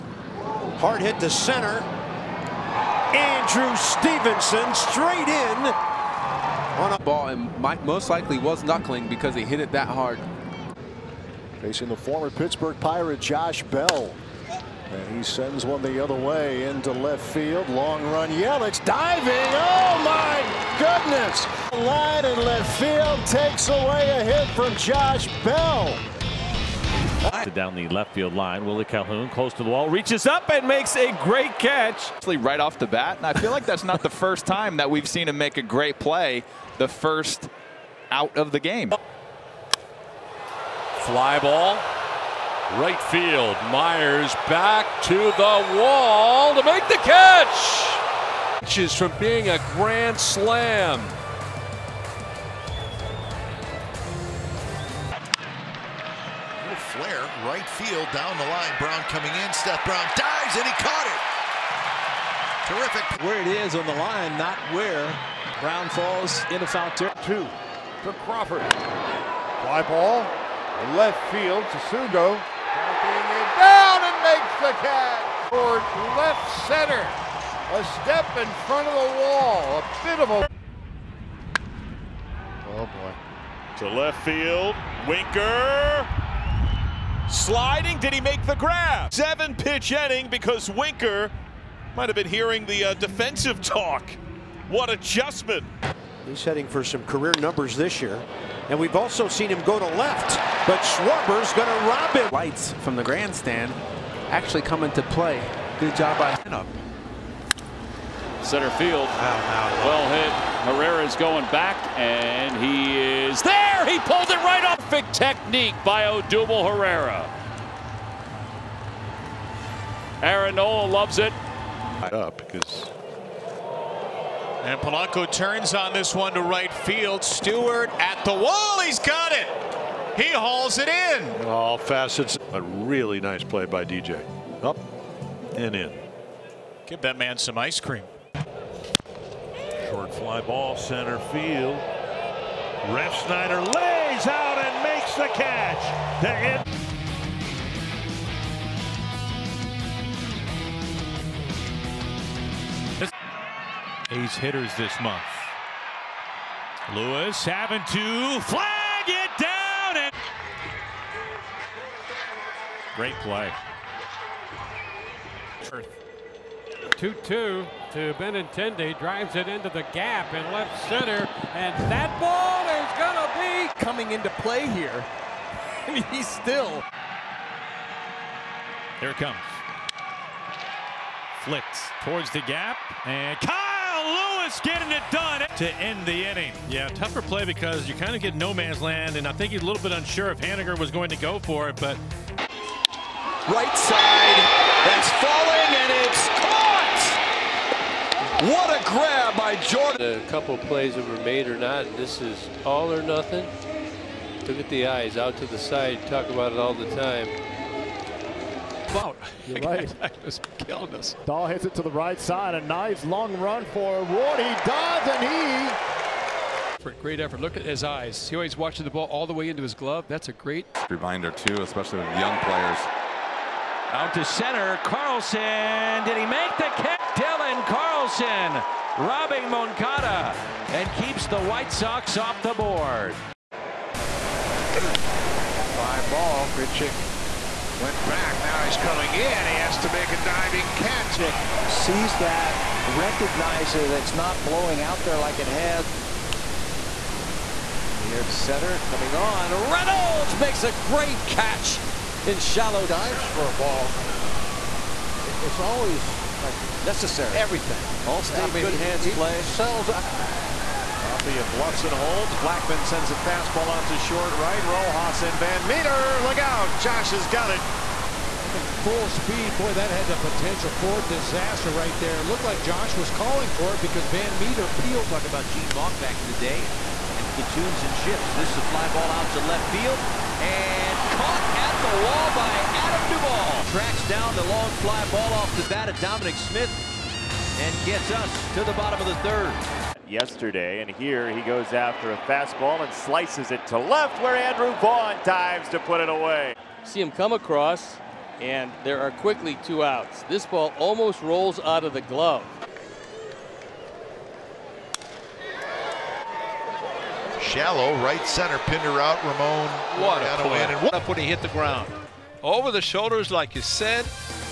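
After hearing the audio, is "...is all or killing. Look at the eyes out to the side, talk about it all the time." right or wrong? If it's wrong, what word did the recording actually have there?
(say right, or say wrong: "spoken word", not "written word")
wrong: "nothing", not "killing".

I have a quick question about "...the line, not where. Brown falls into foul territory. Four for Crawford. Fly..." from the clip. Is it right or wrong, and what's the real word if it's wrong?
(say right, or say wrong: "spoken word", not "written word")
wrong: "Two", not "Four".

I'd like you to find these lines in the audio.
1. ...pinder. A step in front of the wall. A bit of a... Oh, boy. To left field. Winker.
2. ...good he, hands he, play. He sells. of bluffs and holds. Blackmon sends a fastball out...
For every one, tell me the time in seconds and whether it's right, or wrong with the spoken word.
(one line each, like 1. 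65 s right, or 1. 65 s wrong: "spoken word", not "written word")
1. 76 s wrong: "center", not "pinder"
2. 258 s right.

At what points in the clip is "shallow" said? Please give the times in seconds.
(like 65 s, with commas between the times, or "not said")
252 s, 307 s.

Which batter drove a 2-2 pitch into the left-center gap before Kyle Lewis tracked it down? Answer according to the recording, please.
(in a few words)
Benintendi.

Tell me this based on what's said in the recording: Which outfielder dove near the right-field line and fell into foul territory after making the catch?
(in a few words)
Seth Brown.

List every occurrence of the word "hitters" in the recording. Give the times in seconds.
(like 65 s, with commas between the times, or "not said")
154 s.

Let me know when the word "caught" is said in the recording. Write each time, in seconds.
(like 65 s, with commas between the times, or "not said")
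60 s, 281 s.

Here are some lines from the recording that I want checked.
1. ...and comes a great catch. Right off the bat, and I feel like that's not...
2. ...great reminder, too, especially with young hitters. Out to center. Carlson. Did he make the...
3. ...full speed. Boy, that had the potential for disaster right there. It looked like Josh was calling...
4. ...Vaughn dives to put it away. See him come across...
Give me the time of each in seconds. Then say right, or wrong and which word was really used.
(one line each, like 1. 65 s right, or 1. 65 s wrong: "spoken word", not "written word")
1. 30 s wrong: "makes", not "comes"
2. 220 s wrong: "players", not "hitters"
3. 268 s right
4. 294 s right.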